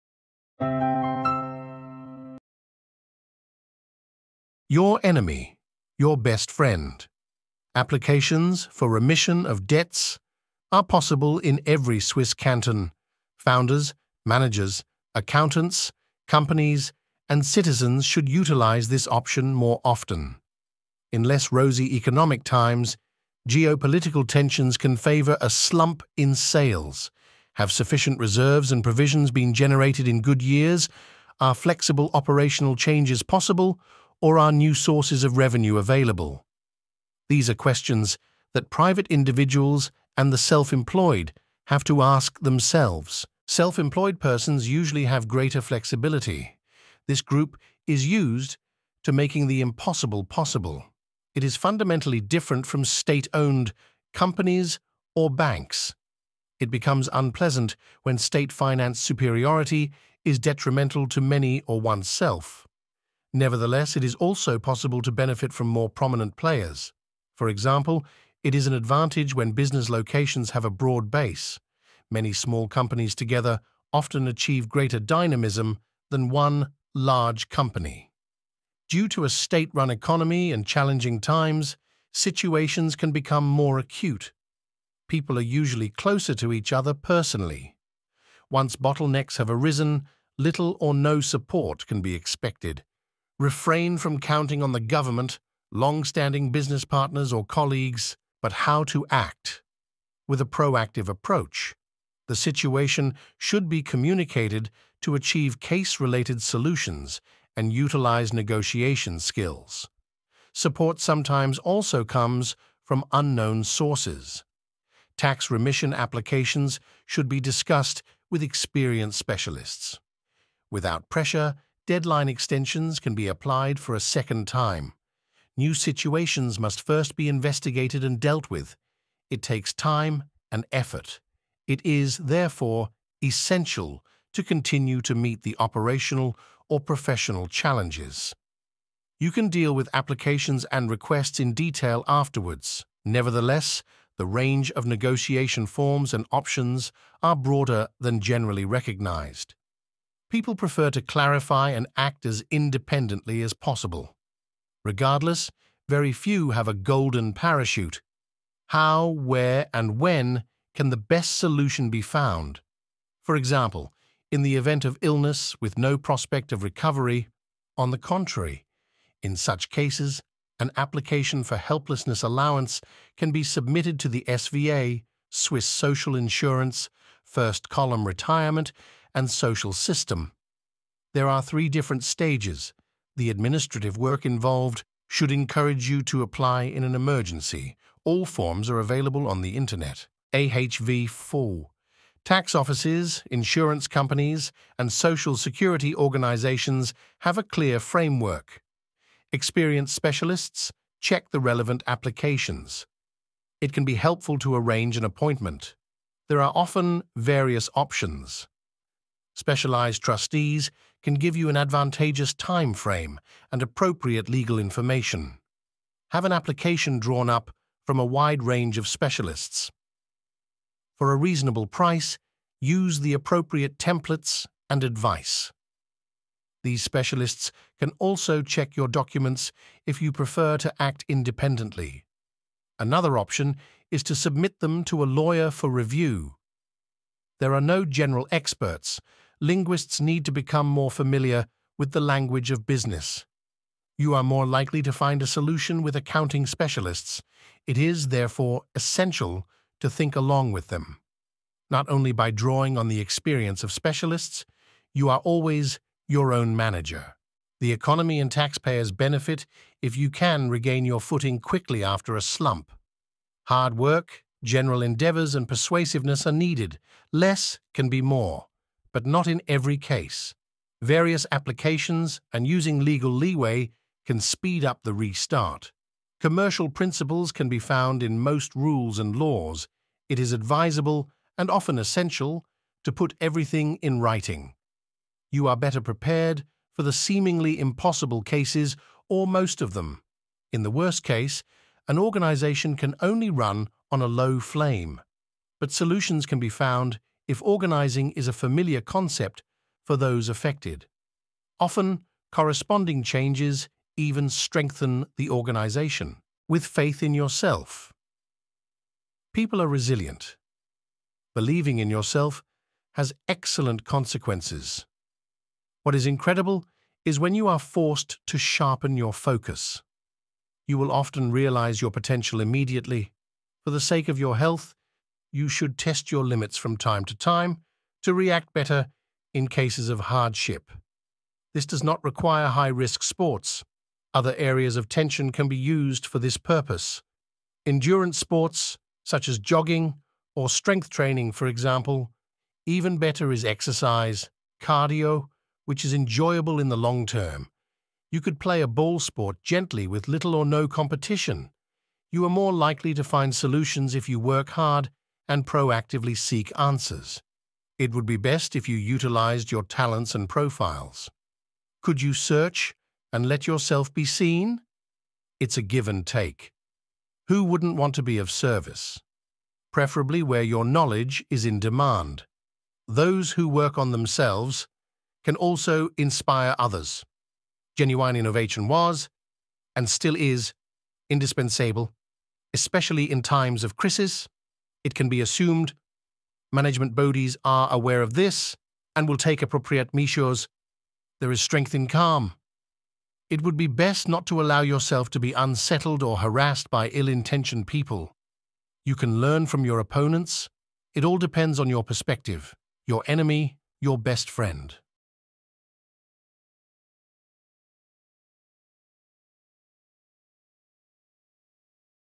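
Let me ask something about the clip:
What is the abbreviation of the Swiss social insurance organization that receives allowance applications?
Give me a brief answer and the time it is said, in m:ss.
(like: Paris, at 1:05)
SVA, at 2:54.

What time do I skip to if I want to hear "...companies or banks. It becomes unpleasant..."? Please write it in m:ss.
0:54.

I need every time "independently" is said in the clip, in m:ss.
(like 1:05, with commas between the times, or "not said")
2:32, 3:51.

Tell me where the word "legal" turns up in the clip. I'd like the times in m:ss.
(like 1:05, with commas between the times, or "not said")
3:34, 4:32.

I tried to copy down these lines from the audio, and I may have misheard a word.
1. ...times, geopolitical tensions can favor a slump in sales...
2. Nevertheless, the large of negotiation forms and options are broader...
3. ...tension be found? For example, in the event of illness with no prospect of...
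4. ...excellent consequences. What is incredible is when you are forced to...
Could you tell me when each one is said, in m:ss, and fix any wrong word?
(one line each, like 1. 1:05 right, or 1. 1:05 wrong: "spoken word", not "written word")
1. 0:22 right
2. 2:23 wrong: "range", not "large"
3. 2:41 wrong: "solution", not "tension"
4. 5:13 right.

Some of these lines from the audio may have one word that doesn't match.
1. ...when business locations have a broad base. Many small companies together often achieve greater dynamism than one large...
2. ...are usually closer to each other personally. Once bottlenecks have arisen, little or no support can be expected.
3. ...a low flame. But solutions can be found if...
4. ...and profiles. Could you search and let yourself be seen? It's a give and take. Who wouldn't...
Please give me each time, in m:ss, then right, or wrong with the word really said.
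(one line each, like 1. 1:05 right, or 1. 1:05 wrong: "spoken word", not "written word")
1. 1:09 right
2. 1:25 right
3. 4:54 right
4. 6:00 right.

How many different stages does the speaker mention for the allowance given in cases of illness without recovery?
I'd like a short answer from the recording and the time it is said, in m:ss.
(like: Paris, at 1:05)
3, at 3:01.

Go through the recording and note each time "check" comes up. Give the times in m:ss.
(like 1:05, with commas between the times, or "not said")
3:20, 3:48.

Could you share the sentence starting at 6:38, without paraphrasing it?
You can learn from your opponents.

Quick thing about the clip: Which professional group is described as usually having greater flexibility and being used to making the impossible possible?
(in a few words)
Self-employed persons.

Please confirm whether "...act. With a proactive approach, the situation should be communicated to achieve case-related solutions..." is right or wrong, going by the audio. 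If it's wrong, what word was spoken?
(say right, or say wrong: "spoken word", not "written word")
right.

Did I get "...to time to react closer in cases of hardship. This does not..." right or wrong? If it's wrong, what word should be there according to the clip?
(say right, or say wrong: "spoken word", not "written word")
wrong: "better", not "closer".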